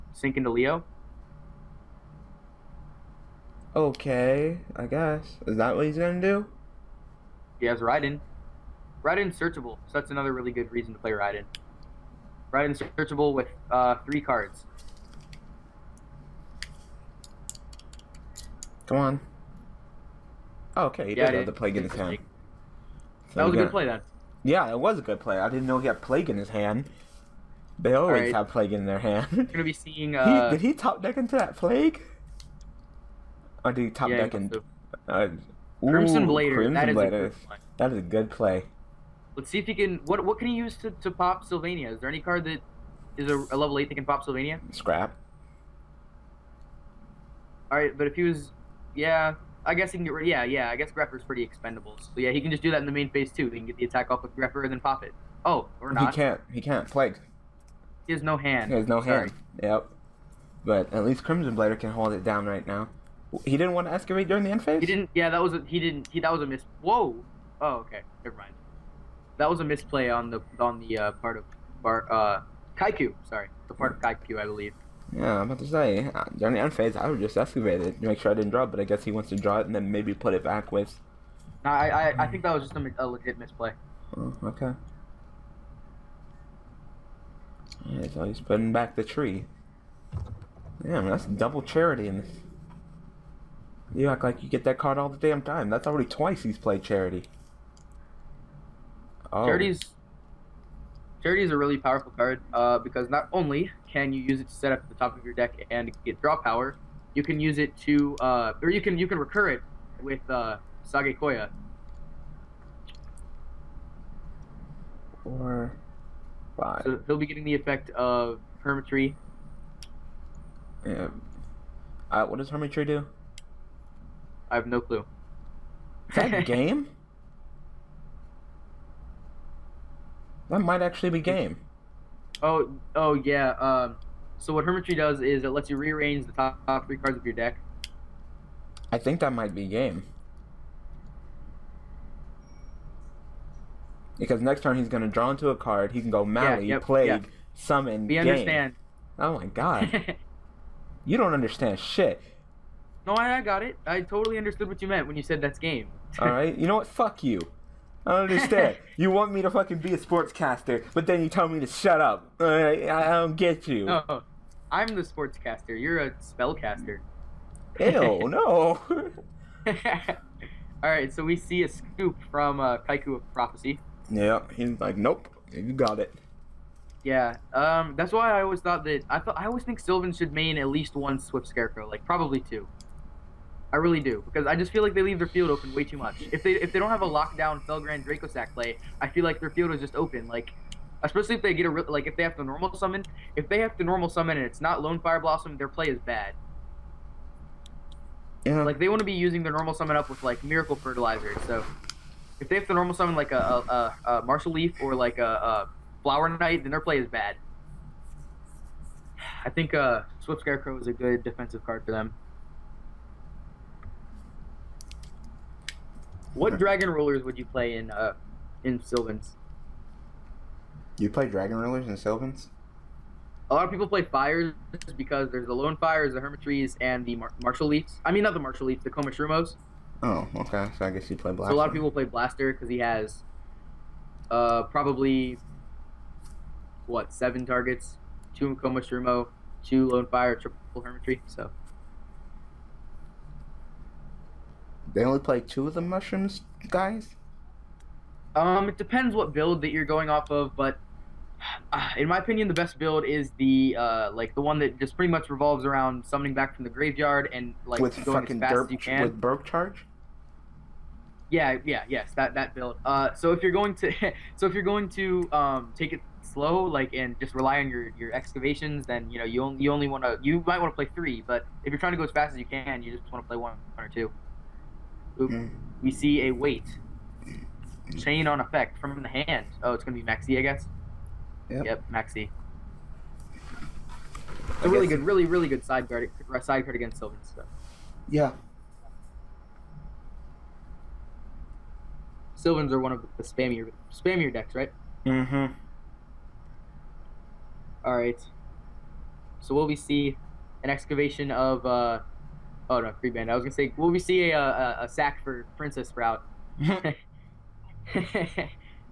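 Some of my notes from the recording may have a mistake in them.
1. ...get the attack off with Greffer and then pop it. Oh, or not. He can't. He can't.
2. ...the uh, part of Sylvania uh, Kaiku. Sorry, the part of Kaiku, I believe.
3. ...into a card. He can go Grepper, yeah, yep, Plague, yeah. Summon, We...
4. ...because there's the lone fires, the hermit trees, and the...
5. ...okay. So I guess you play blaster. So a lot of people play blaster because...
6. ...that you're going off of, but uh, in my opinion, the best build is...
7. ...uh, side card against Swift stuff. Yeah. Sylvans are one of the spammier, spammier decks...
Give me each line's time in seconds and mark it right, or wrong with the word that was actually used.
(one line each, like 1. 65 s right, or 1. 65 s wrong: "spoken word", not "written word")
1. 53 s right
2. 70 s wrong: "Bar", not "Sylvania"
3. 145 s wrong: "Mally", not "Grepper"
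4. 224 s right
5. 230 s right
6. 249 s right
7. 286 s wrong: "Sylvan", not "Swift".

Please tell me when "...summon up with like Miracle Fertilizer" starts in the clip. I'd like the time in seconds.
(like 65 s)
199 s.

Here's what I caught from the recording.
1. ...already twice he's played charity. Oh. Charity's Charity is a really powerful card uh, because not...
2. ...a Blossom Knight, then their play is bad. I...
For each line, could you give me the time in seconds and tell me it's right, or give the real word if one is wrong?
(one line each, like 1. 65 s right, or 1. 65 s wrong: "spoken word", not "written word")
1. 95 s right
2. 205 s wrong: "Flower", not "Blossom".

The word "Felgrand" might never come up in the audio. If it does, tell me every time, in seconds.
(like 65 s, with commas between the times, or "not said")
187 s.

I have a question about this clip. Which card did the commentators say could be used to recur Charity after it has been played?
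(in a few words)
Sagequoia.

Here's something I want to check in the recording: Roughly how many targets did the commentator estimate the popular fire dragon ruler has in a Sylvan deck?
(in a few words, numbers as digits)
7.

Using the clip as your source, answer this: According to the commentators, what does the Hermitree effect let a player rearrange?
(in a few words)
top three cards.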